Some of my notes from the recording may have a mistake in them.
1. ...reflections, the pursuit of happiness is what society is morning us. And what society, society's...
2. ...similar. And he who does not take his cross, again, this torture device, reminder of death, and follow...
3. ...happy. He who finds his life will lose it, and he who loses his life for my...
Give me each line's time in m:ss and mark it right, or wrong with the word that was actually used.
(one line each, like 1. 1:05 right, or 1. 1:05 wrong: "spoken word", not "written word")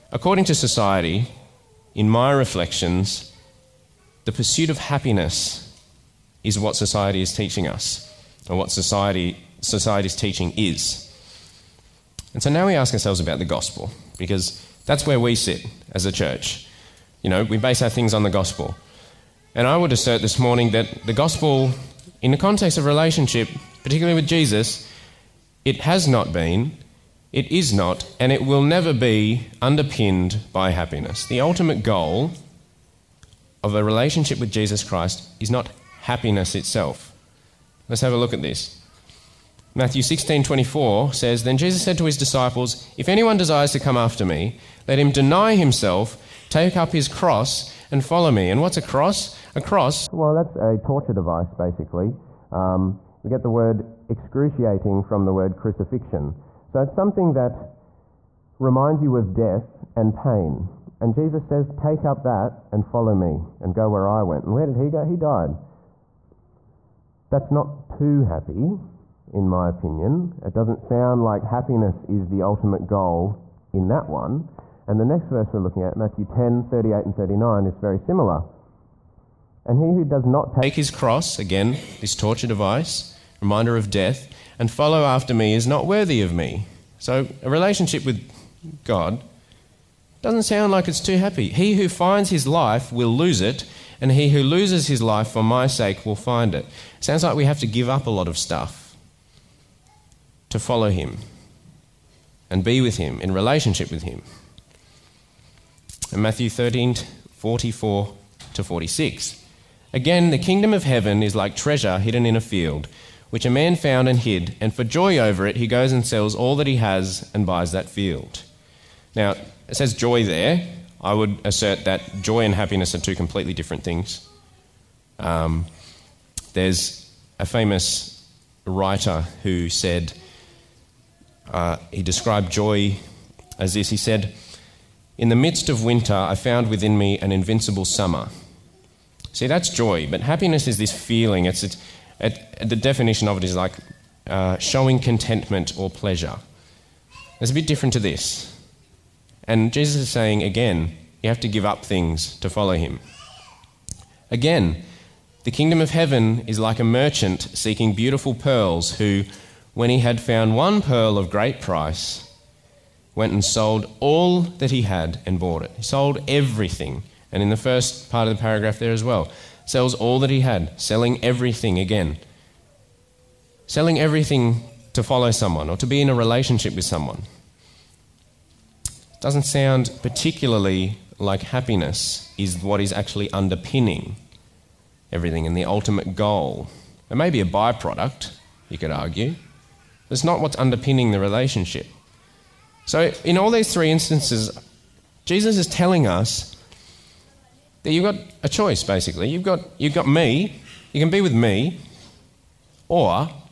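1. 0:02 wrong: "teaching", not "morning"
2. 1:17 right
3. 1:31 right.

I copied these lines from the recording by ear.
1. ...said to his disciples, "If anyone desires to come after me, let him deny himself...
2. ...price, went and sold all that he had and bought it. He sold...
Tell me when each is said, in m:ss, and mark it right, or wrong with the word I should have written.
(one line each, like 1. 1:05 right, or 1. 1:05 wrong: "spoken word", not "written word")
1. 0:41 right
2. 2:41 right.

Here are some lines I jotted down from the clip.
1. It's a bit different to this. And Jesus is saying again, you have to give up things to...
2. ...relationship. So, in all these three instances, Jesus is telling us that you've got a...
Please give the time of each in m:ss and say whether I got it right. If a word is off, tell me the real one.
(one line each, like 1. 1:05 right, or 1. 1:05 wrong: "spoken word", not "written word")
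1. 2:27 right
2. 3:11 right.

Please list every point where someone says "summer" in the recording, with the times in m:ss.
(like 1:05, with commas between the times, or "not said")
2:17.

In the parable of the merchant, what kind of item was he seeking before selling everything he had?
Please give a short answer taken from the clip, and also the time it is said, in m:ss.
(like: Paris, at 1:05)
beautiful pearls, at 2:37.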